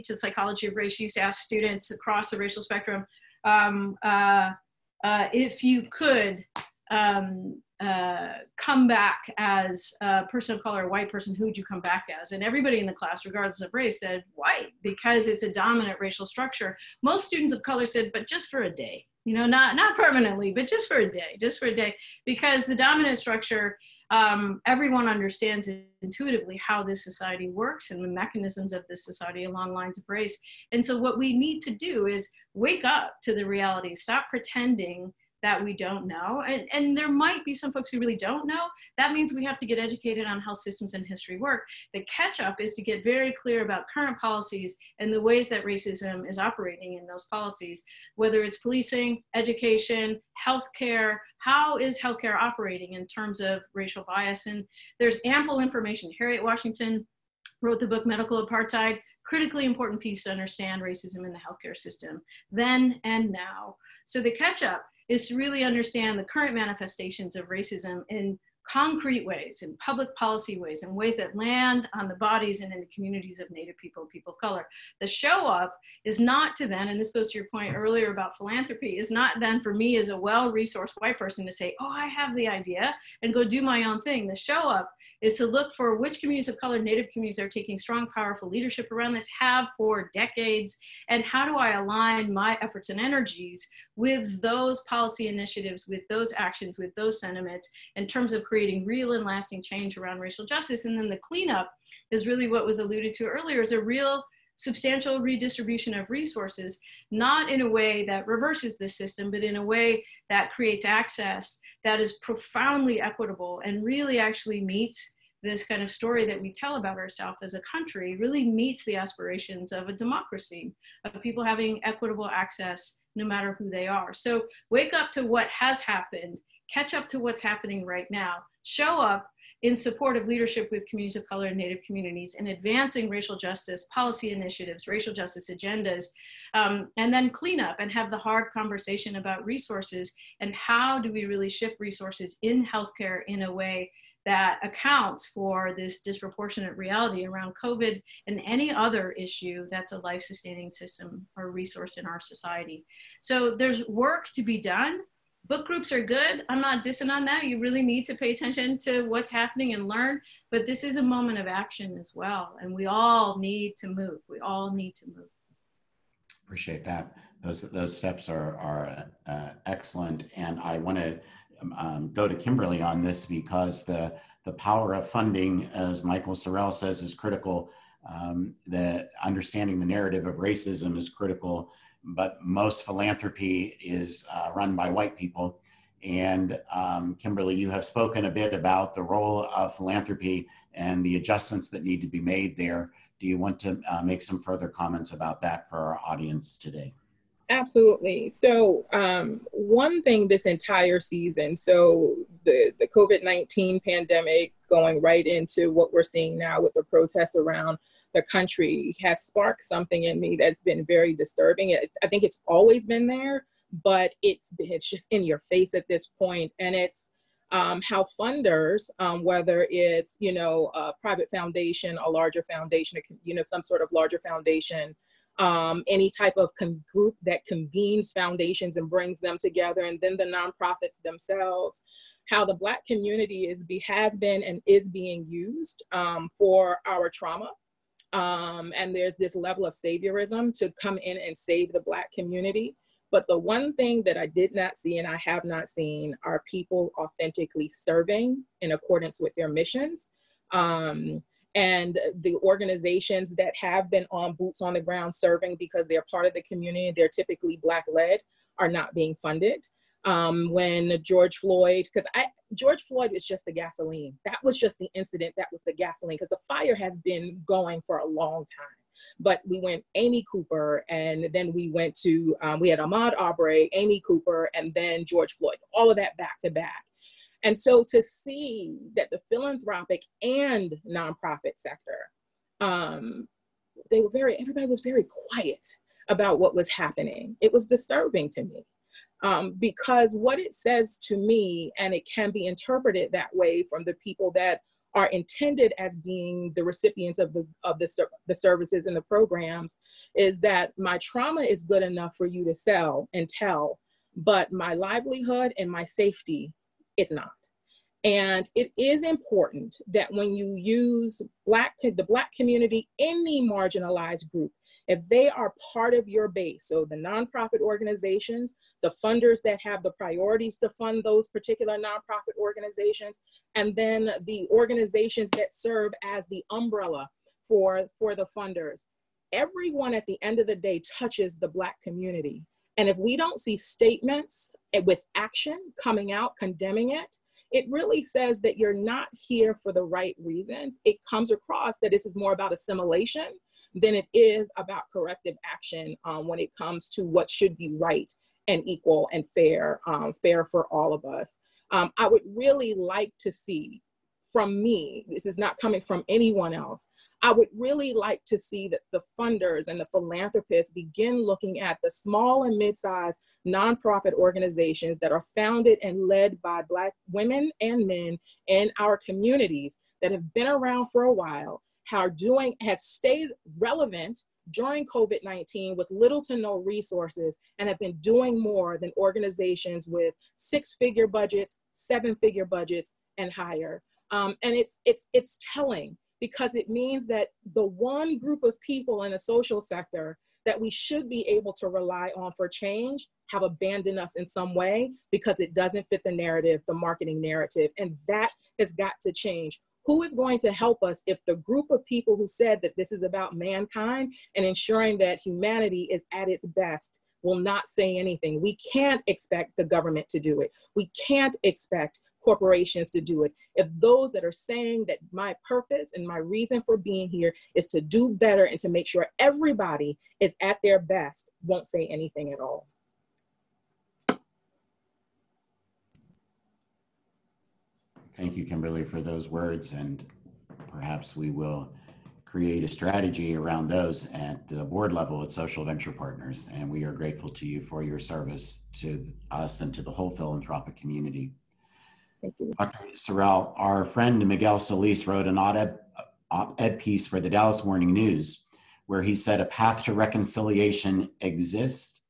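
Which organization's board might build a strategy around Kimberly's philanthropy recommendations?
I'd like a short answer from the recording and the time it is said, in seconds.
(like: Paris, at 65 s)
Social Venture Partners, at 435 s.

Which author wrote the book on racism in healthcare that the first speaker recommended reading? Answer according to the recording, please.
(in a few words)
Harriet Washington.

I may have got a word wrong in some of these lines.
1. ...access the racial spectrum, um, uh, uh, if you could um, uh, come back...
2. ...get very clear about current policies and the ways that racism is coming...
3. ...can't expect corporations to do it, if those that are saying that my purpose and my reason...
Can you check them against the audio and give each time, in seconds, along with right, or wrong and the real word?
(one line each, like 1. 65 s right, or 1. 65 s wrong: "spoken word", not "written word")
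1. 1 s wrong: "across", not "access"
2. 42 s wrong: "operating", not "coming"
3. 411 s right.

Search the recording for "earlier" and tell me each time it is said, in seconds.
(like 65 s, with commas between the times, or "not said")
77 s, 103 s.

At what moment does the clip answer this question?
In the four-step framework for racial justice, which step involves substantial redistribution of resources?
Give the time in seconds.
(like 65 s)
101 s.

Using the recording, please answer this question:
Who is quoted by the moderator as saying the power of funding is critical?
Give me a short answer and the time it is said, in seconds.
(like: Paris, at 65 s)
Michael Sorrell, at 176 s.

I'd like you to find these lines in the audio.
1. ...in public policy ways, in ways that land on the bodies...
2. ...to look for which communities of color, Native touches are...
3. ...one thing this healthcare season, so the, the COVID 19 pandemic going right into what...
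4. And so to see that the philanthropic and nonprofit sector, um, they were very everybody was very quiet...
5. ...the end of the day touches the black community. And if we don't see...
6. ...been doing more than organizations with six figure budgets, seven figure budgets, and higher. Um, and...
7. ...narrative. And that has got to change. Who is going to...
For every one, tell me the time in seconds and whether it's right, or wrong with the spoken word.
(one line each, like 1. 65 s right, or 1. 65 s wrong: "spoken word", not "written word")
1. 69 s right
2. 85 s wrong: "communities", not "touches"
3. 199 s wrong: "entire", not "healthcare"
4. 277 s right
5. 330 s right
6. 377 s right
7. 397 s right.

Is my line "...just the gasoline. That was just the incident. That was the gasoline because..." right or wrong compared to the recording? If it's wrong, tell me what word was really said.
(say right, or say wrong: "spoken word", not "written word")
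right.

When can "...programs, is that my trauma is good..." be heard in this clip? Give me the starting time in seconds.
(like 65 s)
299 s.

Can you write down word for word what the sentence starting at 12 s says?
And everybody in the class, regardless of race, said white because it's a dominant racial structure.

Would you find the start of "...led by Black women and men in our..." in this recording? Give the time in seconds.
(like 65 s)
366 s.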